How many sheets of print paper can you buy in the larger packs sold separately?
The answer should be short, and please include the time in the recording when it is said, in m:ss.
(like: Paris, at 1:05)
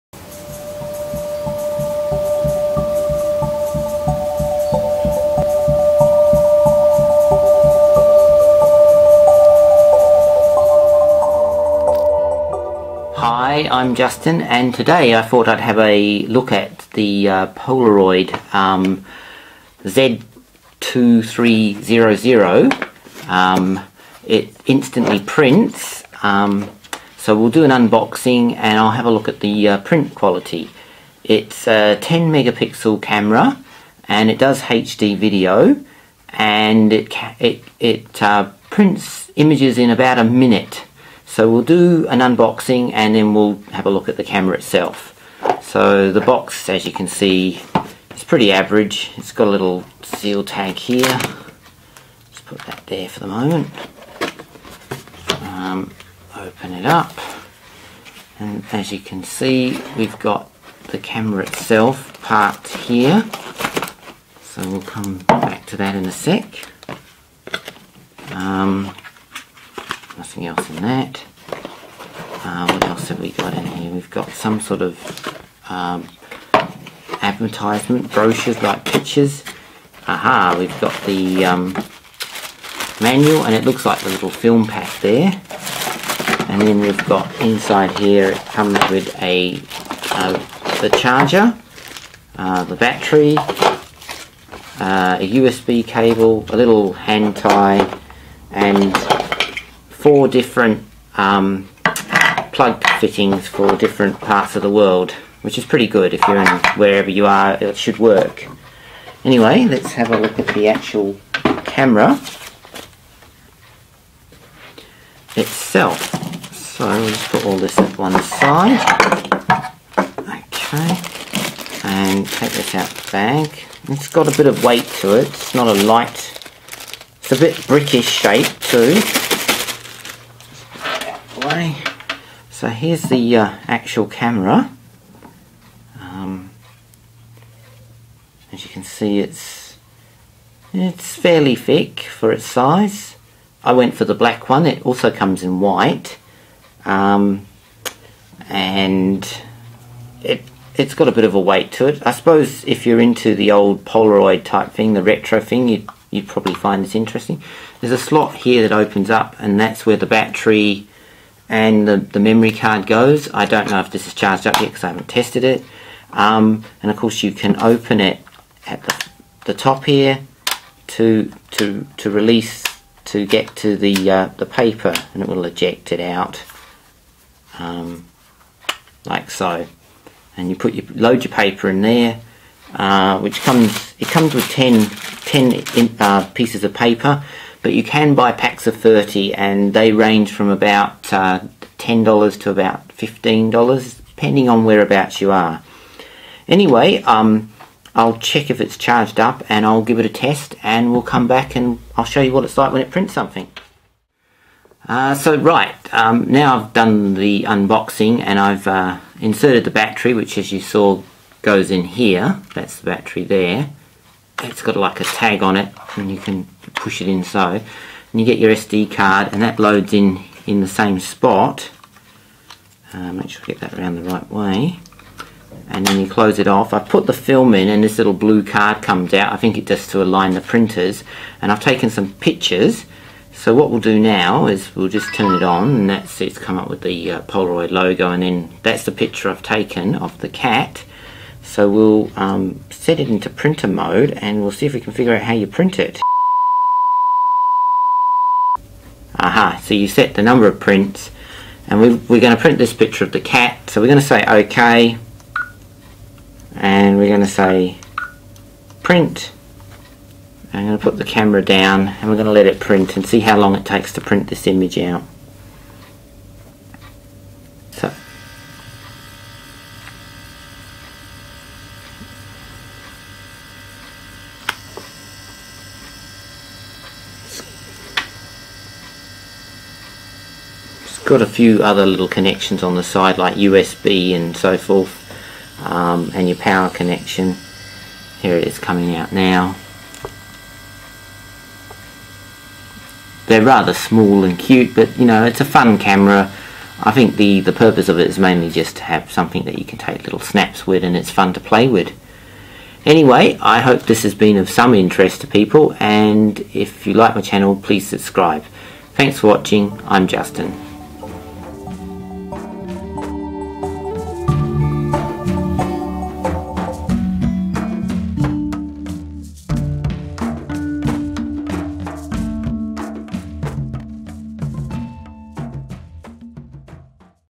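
30, at 3:08.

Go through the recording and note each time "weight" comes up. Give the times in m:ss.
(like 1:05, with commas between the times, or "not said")
2:04, 2:31.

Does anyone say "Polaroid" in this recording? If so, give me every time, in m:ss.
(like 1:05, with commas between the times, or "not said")
0:17, 2:33, 3:57.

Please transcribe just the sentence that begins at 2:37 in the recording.
There's a slot here that opens up and that's where the battery and the, the memory card goes.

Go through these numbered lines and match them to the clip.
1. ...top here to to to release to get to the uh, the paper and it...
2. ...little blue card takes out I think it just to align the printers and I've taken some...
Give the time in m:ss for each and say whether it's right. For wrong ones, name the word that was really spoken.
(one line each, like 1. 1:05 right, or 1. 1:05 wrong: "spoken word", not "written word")
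1. 2:49 right
2. 3:47 wrong: "comes", not "takes".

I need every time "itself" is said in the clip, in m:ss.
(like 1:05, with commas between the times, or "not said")
0:44, 1:01, 1:55.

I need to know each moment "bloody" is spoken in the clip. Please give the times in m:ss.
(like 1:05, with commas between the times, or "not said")
not said.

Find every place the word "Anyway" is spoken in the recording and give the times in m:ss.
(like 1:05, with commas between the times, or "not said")
1:49, 3:16, 5:02.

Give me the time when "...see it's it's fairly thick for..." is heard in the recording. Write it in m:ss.
2:18.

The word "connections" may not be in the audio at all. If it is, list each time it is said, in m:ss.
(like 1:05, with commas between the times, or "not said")
4:42, 4:46.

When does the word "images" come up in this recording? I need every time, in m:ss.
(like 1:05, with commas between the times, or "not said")
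0:39, 4:24.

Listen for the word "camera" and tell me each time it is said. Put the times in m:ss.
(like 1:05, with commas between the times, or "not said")
0:33, 0:44, 1:00, 1:51, 2:14, 4:21, 4:55.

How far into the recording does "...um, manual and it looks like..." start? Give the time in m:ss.
1:21.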